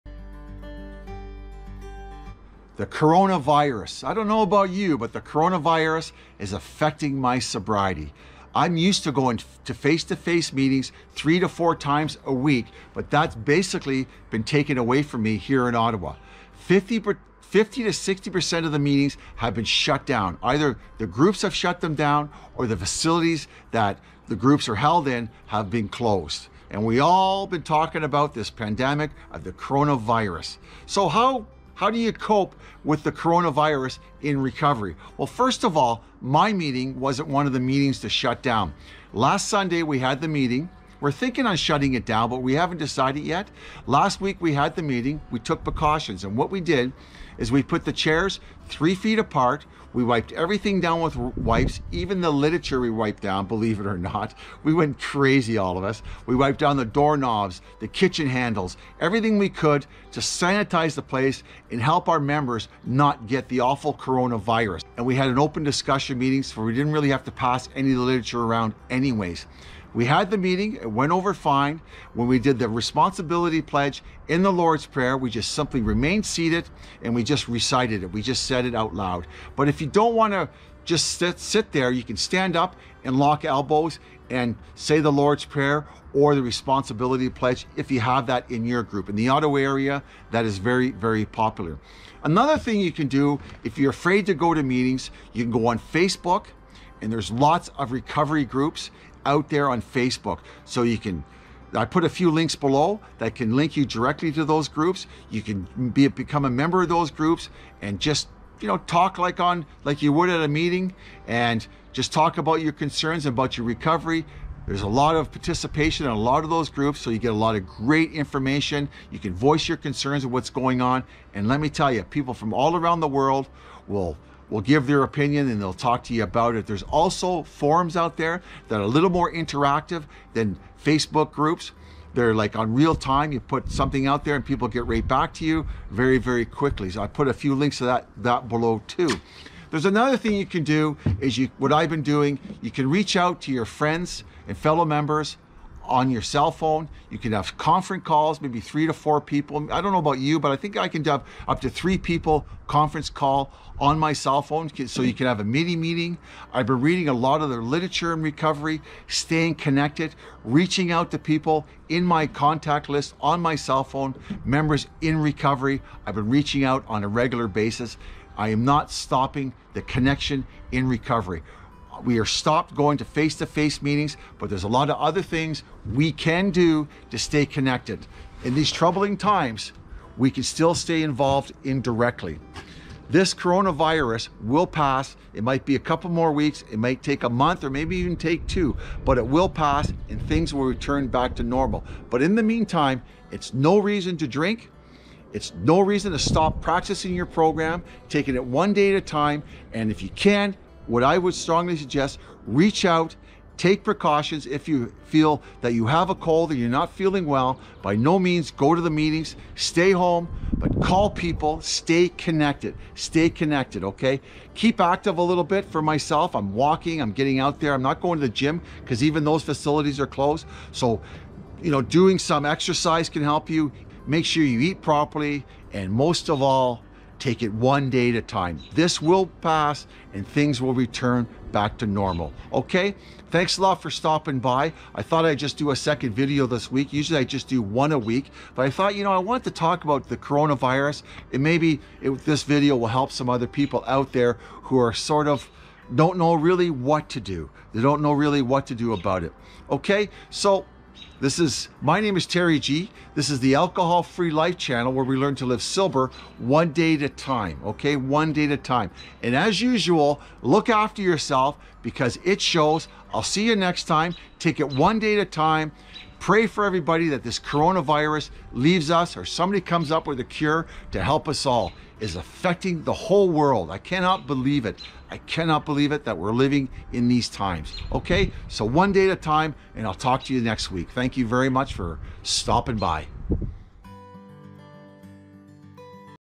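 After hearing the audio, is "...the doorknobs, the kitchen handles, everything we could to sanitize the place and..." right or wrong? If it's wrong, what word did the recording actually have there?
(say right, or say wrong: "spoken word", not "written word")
right.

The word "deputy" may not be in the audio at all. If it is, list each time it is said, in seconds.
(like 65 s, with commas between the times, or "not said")
not said.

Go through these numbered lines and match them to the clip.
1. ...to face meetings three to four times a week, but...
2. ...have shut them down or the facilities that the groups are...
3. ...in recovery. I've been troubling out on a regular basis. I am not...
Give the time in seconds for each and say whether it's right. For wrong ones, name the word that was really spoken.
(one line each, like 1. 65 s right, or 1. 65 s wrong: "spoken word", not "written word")
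1. 10 s right
2. 21 s right
3. 165 s wrong: "reaching", not "troubling".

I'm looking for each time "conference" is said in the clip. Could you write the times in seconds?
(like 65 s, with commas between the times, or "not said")
147 s, 152 s.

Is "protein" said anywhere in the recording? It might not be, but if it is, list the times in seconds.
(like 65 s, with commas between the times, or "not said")
not said.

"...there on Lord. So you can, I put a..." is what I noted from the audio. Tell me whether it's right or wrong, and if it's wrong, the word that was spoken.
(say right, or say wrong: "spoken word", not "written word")
wrong: "Facebook", not "Lord".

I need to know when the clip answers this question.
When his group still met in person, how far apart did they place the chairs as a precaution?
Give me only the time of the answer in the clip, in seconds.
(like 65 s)
48 s.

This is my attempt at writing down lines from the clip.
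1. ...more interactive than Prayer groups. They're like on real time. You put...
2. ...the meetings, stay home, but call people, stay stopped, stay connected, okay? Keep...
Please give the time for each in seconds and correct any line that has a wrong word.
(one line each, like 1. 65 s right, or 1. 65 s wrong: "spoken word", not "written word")
1. 129 s wrong: "Facebook", not "Prayer"
2. 208 s wrong: "connected", not "stopped".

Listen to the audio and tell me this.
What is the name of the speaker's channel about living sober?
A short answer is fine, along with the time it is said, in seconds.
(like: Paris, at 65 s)
Alcohol Free Life, at 253 s.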